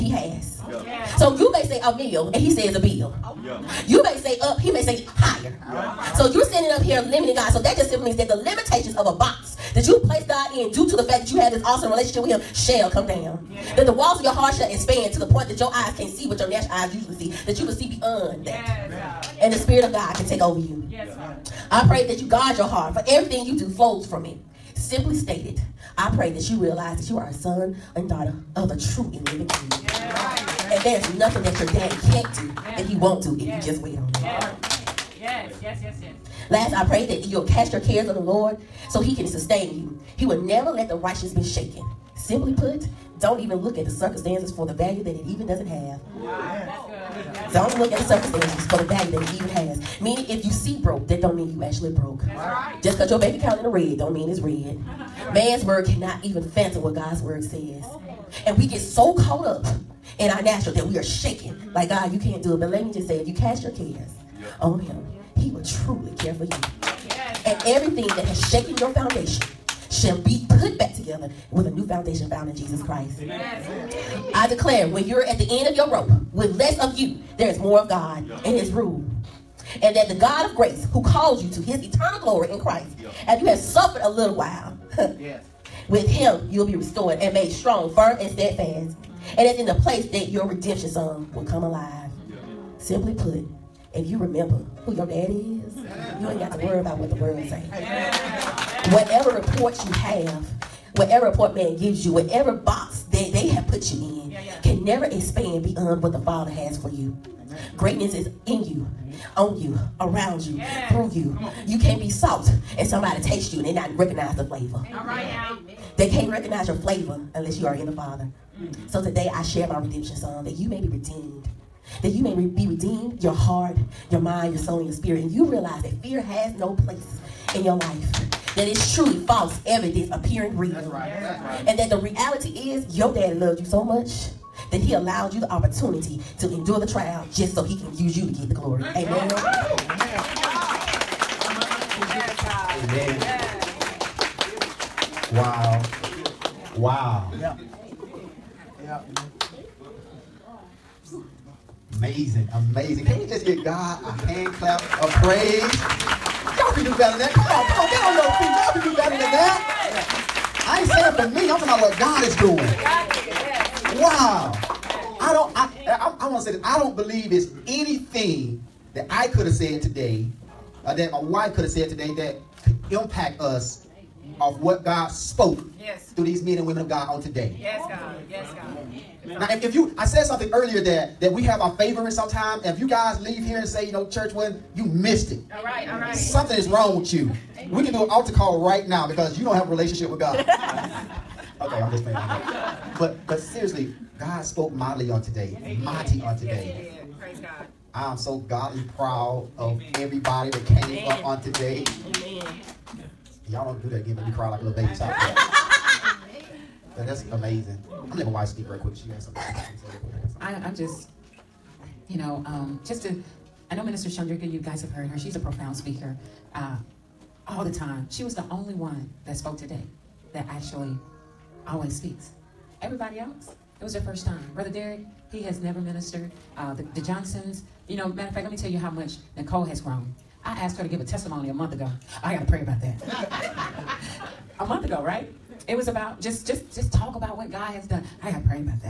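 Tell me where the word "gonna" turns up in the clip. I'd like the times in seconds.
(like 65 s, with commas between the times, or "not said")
208 s.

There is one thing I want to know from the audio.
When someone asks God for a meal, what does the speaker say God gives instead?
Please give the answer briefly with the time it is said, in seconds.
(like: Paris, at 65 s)
A bill, at 2 s.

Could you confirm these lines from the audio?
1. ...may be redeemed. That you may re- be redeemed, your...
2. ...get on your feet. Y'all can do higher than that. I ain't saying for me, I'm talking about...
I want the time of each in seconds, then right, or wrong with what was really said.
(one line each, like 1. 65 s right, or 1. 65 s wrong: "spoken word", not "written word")
1. 120 s right
2. 157 s wrong: "better", not "higher".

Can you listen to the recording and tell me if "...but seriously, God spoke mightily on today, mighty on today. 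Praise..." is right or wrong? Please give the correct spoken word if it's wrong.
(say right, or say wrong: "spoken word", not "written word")
right.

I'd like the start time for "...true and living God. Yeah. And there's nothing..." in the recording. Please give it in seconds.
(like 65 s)
28 s.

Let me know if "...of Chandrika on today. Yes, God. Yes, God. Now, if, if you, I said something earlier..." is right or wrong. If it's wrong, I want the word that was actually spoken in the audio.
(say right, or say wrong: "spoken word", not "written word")
wrong: "God", not "Chandrika".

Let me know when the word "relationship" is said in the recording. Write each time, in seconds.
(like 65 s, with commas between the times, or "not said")
11 s, 189 s.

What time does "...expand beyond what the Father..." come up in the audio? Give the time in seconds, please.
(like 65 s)
105 s.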